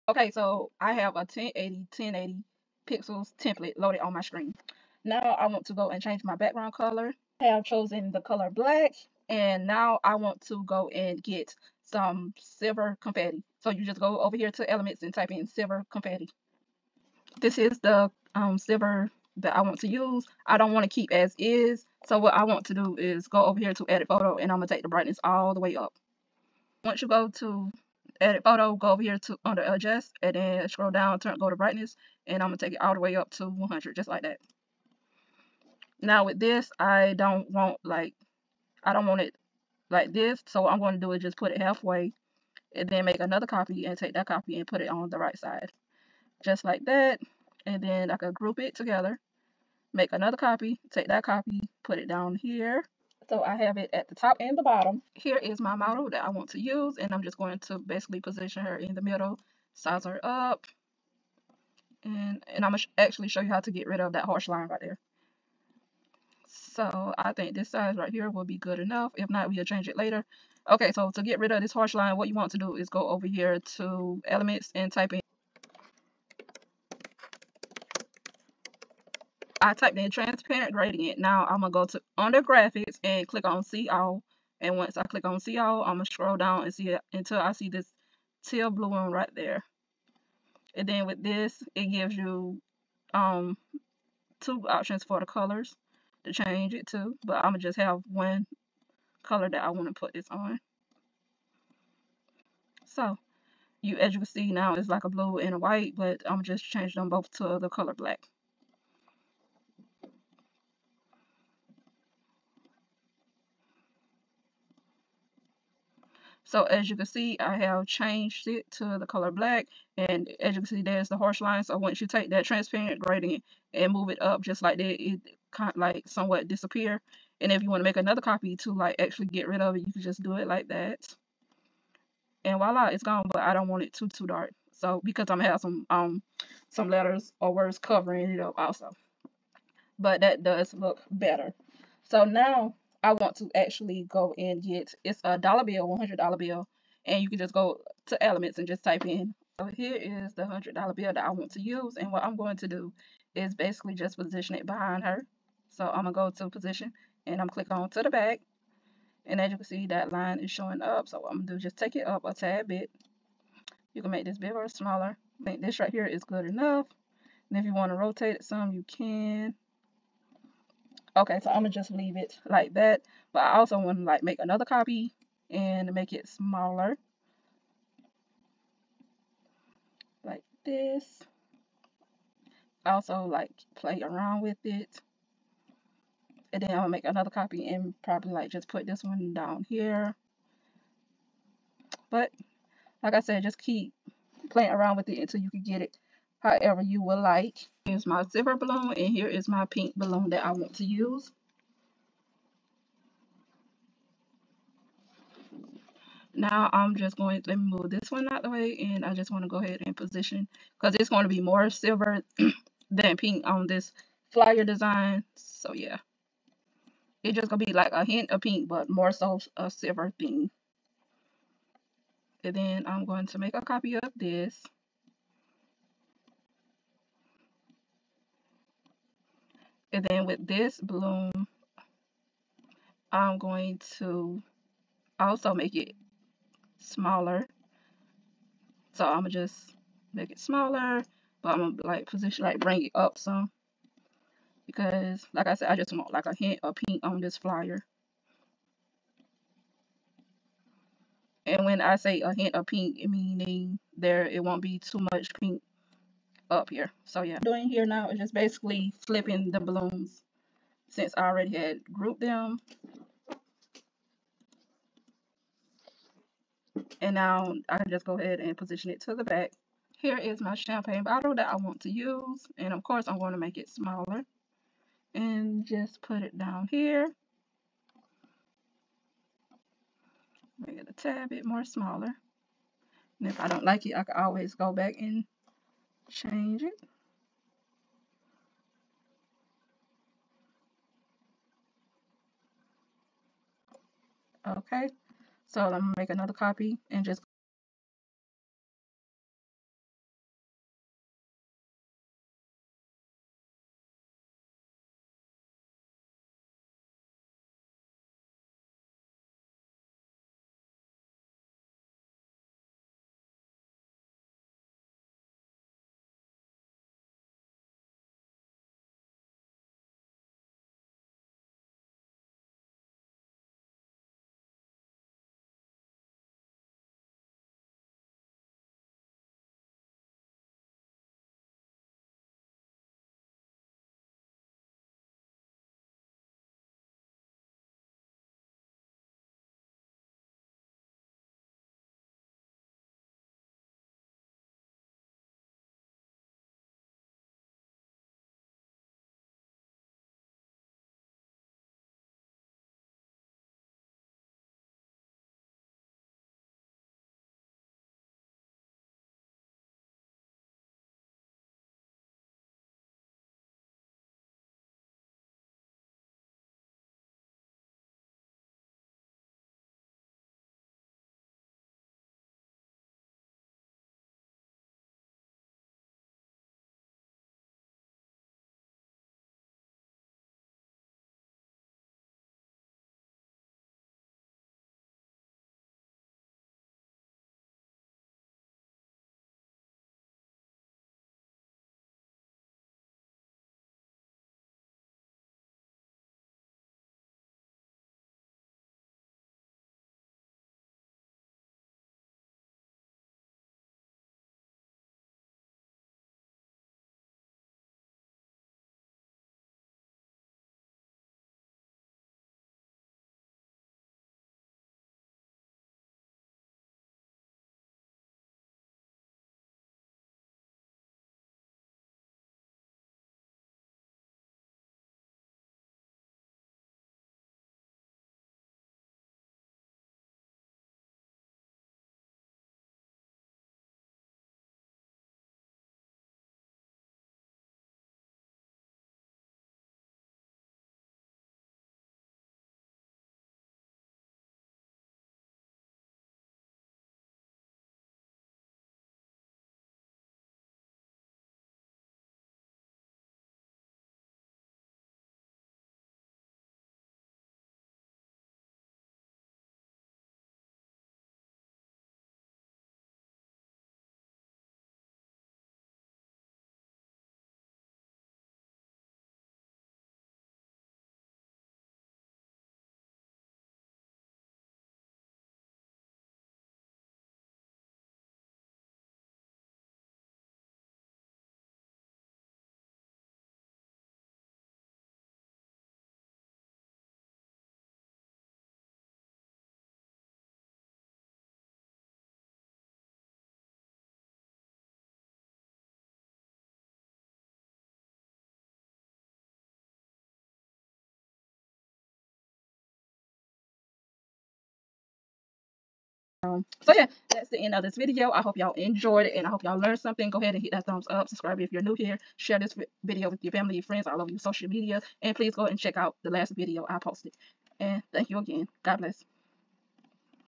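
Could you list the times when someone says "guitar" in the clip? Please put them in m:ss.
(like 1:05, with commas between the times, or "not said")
not said.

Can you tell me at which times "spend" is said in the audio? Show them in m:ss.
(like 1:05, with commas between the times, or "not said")
not said.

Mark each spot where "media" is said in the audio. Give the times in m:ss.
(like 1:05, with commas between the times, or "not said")
8:34.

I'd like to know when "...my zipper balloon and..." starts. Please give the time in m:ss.
3:18.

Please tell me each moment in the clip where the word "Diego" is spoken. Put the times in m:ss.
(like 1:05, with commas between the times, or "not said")
not said.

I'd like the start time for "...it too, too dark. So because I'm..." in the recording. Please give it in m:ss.
2:13.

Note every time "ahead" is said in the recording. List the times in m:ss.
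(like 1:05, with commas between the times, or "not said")
3:29, 4:28, 8:30.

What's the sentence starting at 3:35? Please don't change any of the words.
So yeah, it's just going to be like a hint of pink but more so a silver theme.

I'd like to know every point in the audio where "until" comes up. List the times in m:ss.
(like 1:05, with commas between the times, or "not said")
1:27, 3:15.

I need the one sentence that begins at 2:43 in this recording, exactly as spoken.
You can make this bigger or smaller.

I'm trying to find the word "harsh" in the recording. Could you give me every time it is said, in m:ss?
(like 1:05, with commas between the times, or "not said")
1:04, 1:11, 2:01.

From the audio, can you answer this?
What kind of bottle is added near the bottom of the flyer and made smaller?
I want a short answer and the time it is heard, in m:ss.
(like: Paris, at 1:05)
champagne, at 4:30.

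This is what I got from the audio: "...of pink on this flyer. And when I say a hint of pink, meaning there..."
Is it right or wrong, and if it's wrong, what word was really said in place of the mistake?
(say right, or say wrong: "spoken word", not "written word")
right.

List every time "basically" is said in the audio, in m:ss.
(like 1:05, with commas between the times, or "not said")
0:57, 2:33, 4:18.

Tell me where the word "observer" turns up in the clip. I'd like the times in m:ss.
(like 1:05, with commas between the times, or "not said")
not said.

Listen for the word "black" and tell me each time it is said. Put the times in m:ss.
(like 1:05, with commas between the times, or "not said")
0:08, 1:47, 1:59.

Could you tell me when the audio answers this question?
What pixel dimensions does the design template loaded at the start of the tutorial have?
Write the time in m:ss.
0:01.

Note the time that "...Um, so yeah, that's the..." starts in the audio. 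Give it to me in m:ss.
8:26.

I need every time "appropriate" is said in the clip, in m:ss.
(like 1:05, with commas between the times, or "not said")
not said.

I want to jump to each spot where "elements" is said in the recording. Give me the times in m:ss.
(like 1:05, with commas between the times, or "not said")
0:14, 1:14, 2:28.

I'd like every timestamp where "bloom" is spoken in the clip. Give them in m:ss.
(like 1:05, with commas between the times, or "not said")
3:50.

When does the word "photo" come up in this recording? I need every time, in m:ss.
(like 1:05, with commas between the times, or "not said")
0:24, 0:28.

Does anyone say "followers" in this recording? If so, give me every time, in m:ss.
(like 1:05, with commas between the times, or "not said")
not said.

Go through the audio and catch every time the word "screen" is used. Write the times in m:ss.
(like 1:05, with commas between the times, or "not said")
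0:04.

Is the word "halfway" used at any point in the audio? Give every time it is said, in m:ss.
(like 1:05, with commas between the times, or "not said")
0:41.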